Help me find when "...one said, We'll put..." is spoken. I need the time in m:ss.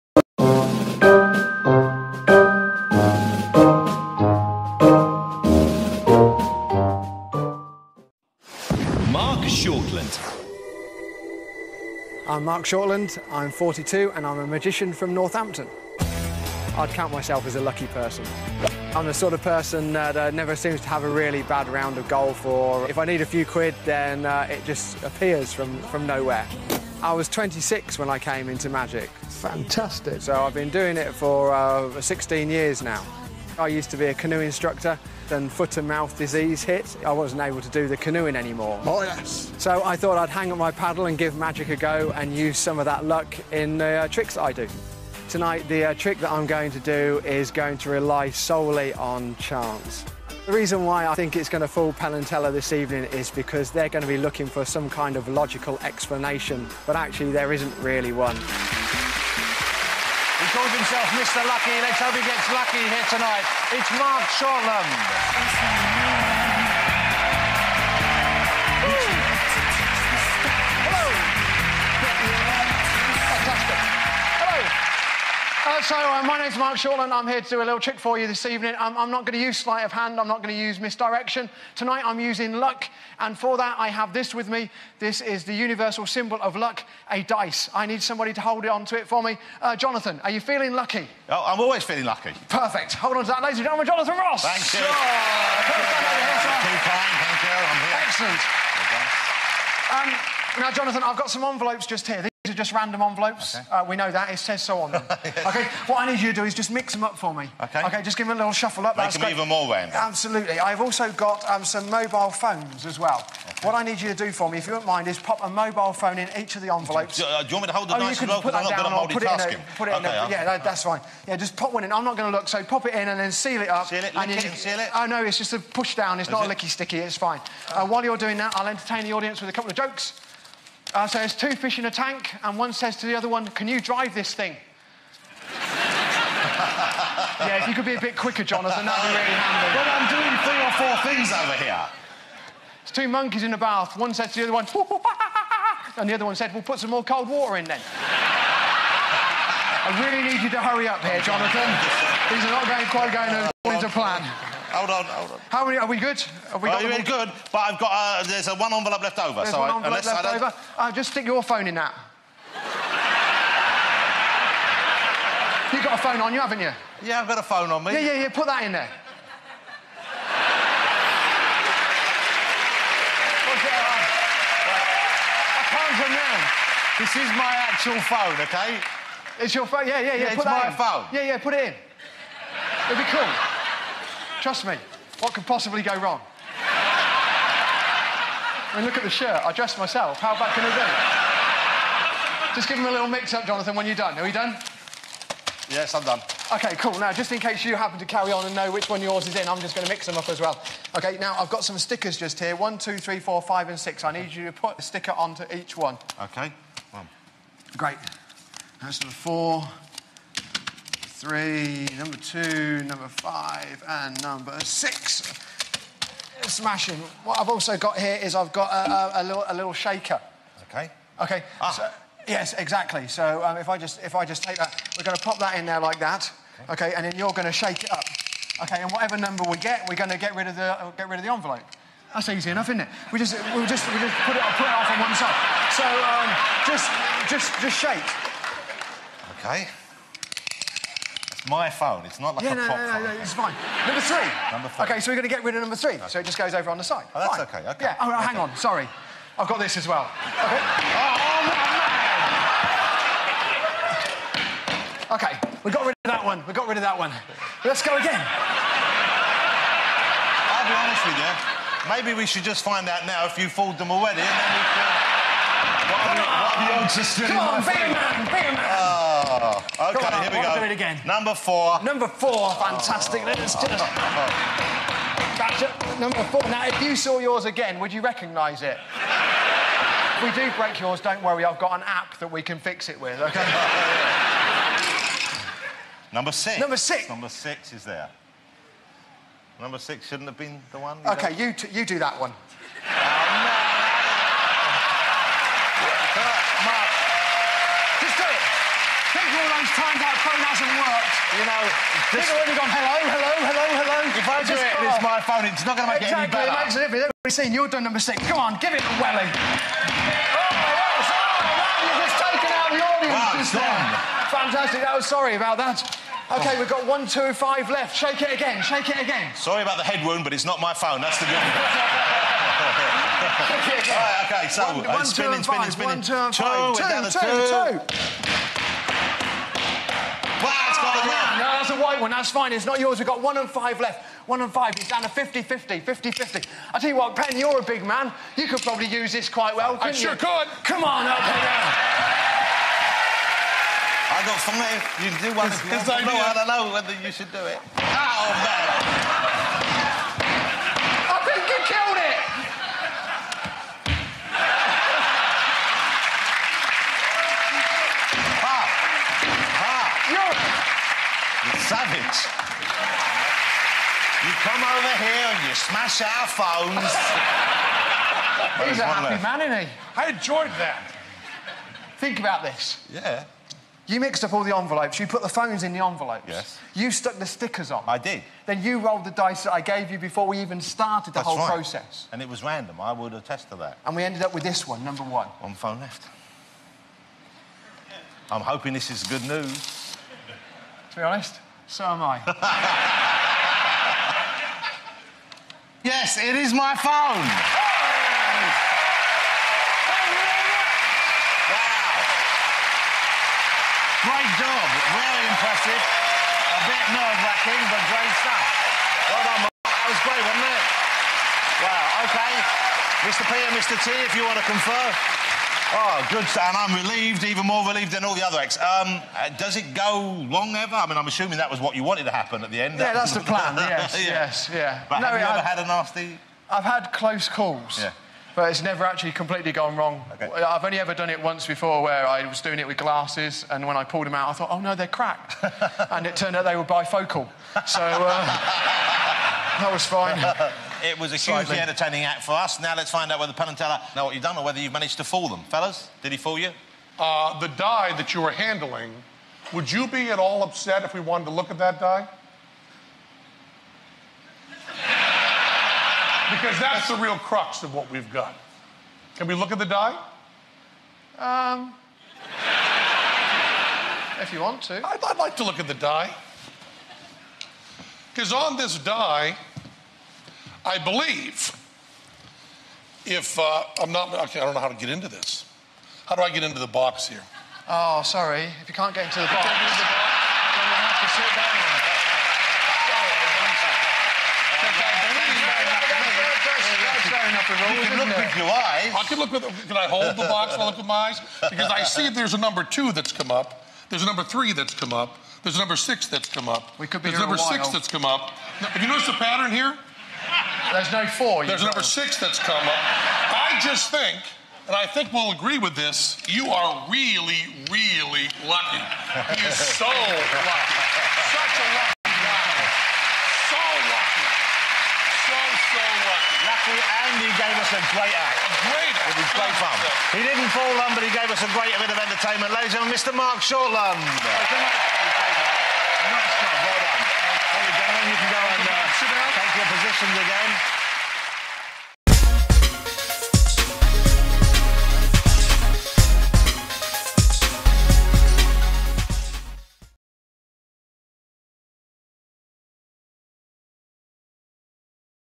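2:26.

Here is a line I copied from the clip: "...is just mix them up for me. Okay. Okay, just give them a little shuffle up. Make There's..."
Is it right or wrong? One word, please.
wrong.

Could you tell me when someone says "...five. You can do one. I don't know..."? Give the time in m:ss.
5:44.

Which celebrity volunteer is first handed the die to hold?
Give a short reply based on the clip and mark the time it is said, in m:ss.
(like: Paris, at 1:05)
Jonathan Ross, at 1:33.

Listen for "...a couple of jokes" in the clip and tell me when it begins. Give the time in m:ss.
2:09.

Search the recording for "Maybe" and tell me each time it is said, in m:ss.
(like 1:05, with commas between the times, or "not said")
4:21.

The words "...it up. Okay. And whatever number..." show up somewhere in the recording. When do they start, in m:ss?
3:47.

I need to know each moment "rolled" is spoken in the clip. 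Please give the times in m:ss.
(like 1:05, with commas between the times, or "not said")
6:18.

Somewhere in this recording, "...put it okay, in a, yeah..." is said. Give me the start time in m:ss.
1:59.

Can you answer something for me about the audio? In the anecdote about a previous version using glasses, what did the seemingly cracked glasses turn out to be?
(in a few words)
Bifocal.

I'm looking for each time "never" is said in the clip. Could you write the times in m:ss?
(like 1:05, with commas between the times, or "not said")
0:20, 7:08.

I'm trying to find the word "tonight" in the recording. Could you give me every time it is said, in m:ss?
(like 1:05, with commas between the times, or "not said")
0:45, 1:03, 1:21.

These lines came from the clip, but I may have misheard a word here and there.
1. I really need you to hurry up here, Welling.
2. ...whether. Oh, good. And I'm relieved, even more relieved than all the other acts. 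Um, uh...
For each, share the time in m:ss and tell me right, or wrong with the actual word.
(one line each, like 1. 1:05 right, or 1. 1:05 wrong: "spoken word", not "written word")
1. 2:29 wrong: "Jonathan", not "Welling"
2. 6:54 wrong: "confer", not "whether".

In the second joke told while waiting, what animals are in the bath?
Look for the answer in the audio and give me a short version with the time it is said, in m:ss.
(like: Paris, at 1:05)
Two monkeys, at 2:22.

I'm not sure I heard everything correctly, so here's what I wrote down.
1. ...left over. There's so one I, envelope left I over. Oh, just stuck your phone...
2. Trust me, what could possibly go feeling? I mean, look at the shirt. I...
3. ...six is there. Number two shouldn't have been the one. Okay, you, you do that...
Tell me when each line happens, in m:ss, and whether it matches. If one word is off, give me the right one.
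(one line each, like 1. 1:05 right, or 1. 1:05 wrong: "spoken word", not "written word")
1. 2:39 wrong: "stick", not "stuck"
2. 3:04 wrong: "wrong", not "feeling"
3. 4:47 wrong: "six", not "two".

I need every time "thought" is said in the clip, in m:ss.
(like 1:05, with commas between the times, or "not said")
0:39, 7:14.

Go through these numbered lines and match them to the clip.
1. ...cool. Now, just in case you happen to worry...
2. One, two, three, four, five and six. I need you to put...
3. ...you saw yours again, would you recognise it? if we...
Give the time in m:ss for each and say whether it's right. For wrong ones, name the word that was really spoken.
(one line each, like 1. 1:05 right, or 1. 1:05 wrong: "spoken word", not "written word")
1. 3:16 wrong: "carry", not "worry"
2. 3:22 right
3. 4:36 right.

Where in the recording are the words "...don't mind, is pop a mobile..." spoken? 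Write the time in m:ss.
1:54.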